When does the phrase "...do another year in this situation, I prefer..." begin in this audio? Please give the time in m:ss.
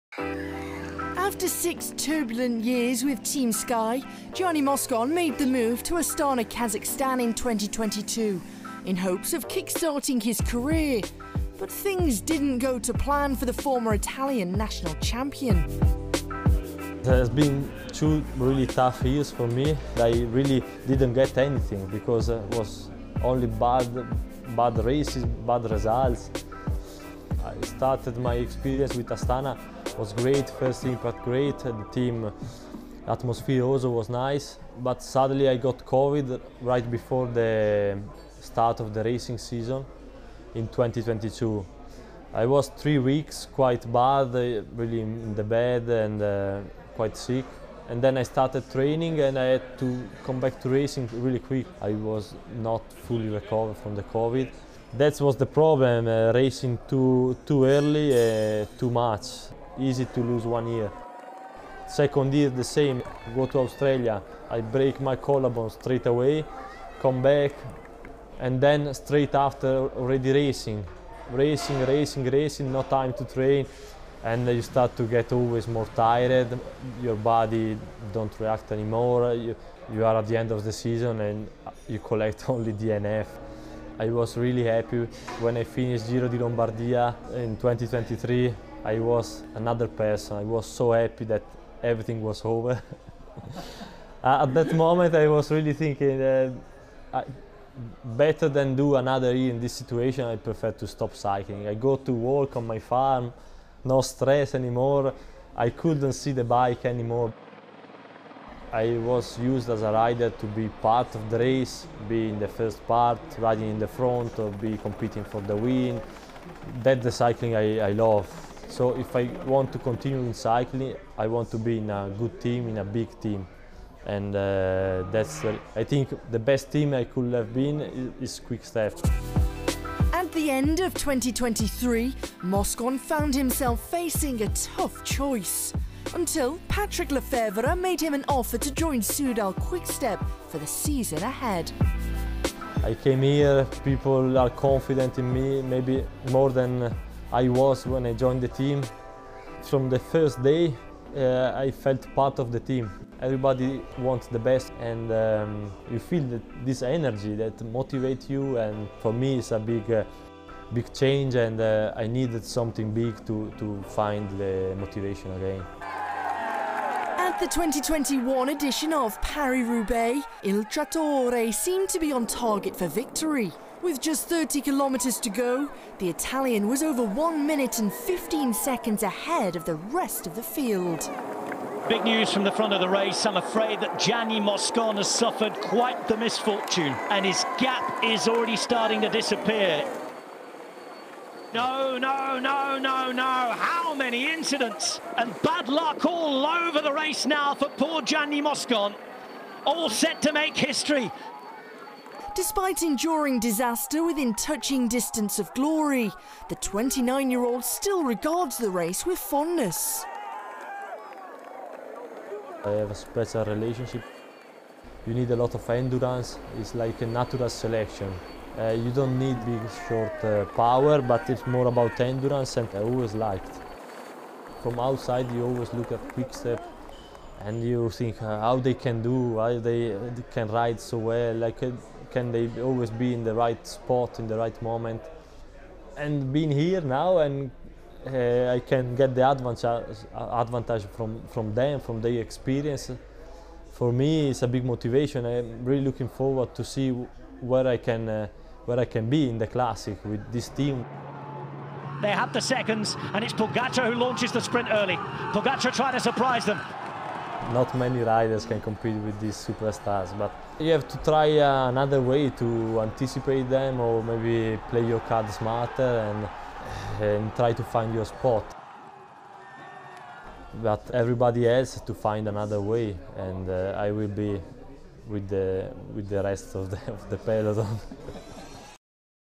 1:38.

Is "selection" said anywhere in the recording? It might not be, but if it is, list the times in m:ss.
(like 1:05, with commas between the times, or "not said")
3:37.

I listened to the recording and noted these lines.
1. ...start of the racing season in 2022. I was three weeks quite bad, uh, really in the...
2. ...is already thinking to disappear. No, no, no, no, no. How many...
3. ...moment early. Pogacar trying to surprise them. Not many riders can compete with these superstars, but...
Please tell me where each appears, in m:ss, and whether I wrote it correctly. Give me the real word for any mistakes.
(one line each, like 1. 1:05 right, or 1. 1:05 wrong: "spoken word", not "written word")
1. 0:38 right
2. 3:08 wrong: "starting", not "thinking"
3. 4:14 wrong: "sprint", not "moment".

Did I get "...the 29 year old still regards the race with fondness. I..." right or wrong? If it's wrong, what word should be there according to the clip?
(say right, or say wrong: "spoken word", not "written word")
right.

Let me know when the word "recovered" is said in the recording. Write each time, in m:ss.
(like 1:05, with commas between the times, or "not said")
0:53.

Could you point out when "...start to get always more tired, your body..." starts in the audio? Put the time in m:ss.
1:14.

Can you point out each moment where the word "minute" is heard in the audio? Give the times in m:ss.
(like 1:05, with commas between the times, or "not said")
2:57.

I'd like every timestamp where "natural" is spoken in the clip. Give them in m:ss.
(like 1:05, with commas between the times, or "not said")
3:37.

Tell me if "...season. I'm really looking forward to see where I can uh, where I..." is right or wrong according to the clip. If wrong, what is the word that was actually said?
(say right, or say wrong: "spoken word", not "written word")
wrong: "motivation", not "season".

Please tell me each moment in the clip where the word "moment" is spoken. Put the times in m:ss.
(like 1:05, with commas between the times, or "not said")
1:34, 3:54.